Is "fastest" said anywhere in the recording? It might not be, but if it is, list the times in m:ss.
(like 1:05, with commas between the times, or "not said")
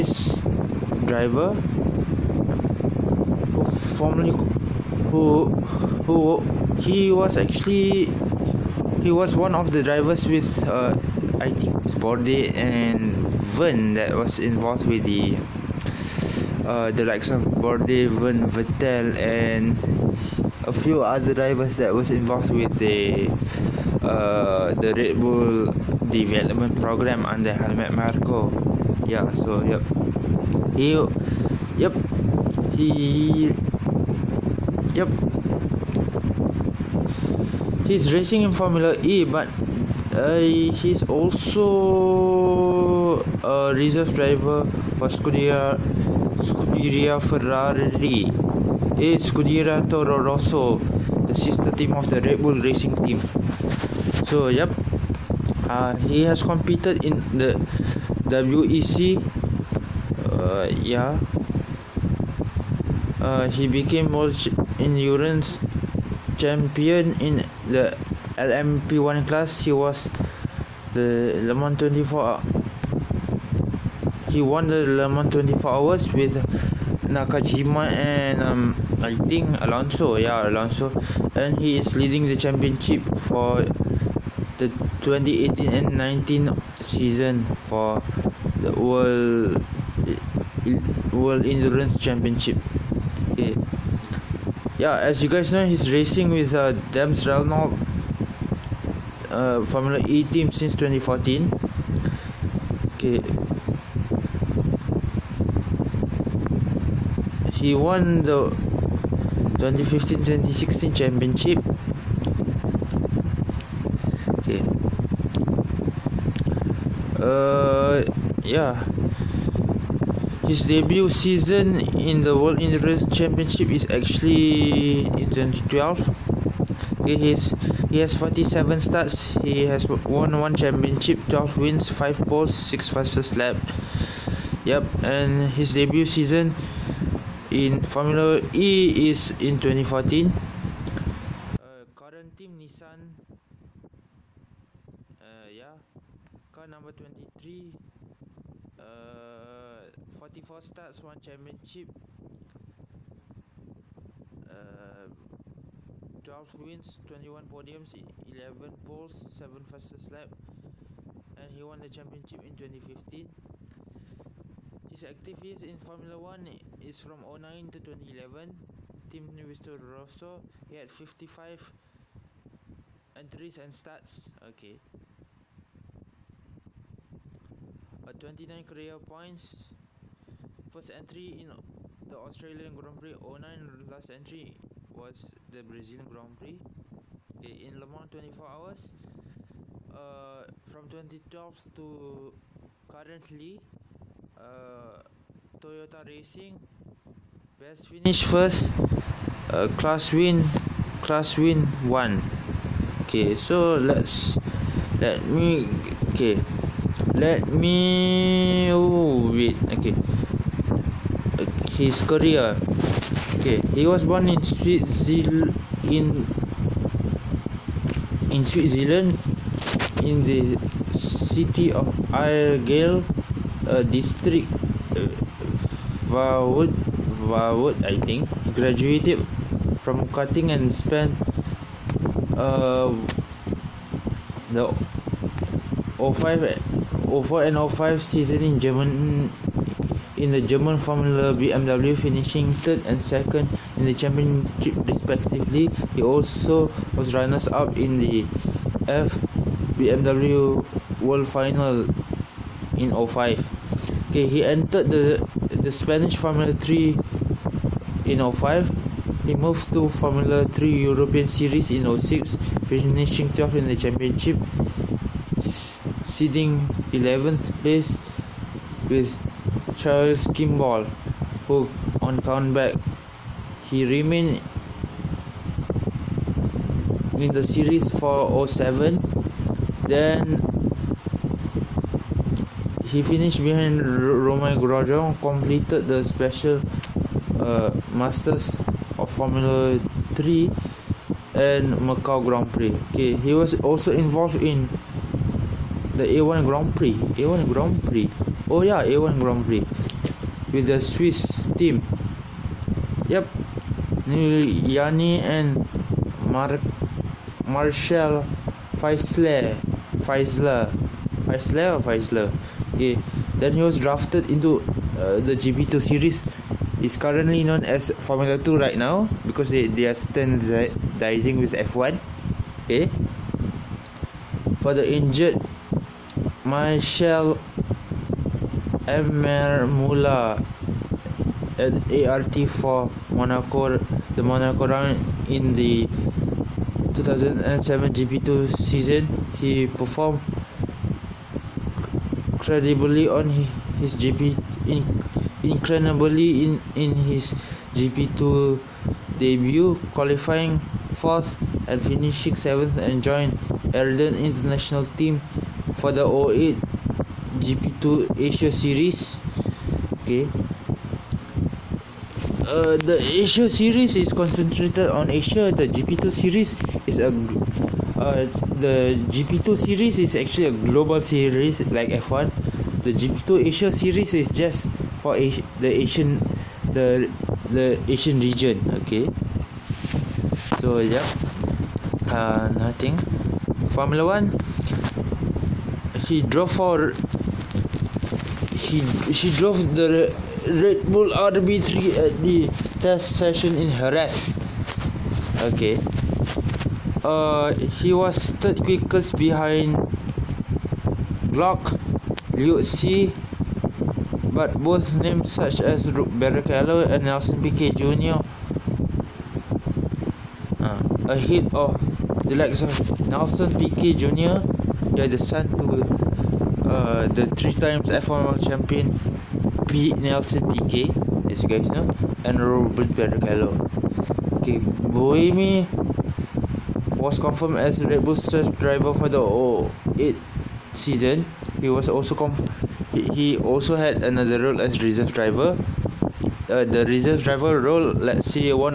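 2:12, 2:39.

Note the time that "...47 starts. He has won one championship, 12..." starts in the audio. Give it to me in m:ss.
2:08.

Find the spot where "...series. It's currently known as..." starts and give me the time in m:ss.
5:15.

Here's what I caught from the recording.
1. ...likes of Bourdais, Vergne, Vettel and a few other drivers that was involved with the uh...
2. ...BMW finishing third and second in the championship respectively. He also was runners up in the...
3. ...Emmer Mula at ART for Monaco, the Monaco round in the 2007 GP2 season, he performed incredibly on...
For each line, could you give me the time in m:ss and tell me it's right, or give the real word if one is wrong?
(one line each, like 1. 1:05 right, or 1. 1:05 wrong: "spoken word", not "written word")
1. 0:17 right
2. 4:01 right
3. 5:28 right.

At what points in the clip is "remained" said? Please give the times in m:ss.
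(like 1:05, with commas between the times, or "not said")
4:33.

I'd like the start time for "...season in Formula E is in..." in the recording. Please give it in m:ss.
2:16.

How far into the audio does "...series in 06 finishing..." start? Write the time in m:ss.
4:21.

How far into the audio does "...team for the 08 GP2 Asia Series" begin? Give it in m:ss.
5:54.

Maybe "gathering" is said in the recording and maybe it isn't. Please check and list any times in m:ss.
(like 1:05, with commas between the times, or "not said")
not said.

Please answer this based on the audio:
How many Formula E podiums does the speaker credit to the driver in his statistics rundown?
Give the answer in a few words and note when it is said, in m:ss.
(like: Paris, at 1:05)
21, at 2:37.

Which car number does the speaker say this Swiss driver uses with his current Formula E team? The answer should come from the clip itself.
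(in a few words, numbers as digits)
23.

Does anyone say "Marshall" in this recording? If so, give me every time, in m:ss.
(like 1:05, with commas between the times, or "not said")
5:07.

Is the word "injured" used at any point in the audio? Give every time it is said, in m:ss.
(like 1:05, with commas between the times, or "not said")
5:24.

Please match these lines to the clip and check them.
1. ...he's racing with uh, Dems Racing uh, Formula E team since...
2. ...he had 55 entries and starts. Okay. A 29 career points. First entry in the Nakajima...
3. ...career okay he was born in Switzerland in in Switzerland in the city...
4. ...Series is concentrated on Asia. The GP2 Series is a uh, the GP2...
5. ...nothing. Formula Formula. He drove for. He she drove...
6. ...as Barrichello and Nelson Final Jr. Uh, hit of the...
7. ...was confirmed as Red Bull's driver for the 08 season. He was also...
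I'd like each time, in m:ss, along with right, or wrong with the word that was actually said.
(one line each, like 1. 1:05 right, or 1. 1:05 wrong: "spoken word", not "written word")
1. 1:35 wrong: "Renault", not "Racing"
2. 2:50 wrong: "Australian", not "Nakajima"
3. 3:32 right
4. 6:03 right
5. 6:22 wrong: "One", not "Formula"
6. 6:45 wrong: "Piquet", not "Final"
7. 7:07 right.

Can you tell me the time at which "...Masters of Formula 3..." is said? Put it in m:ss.
4:47.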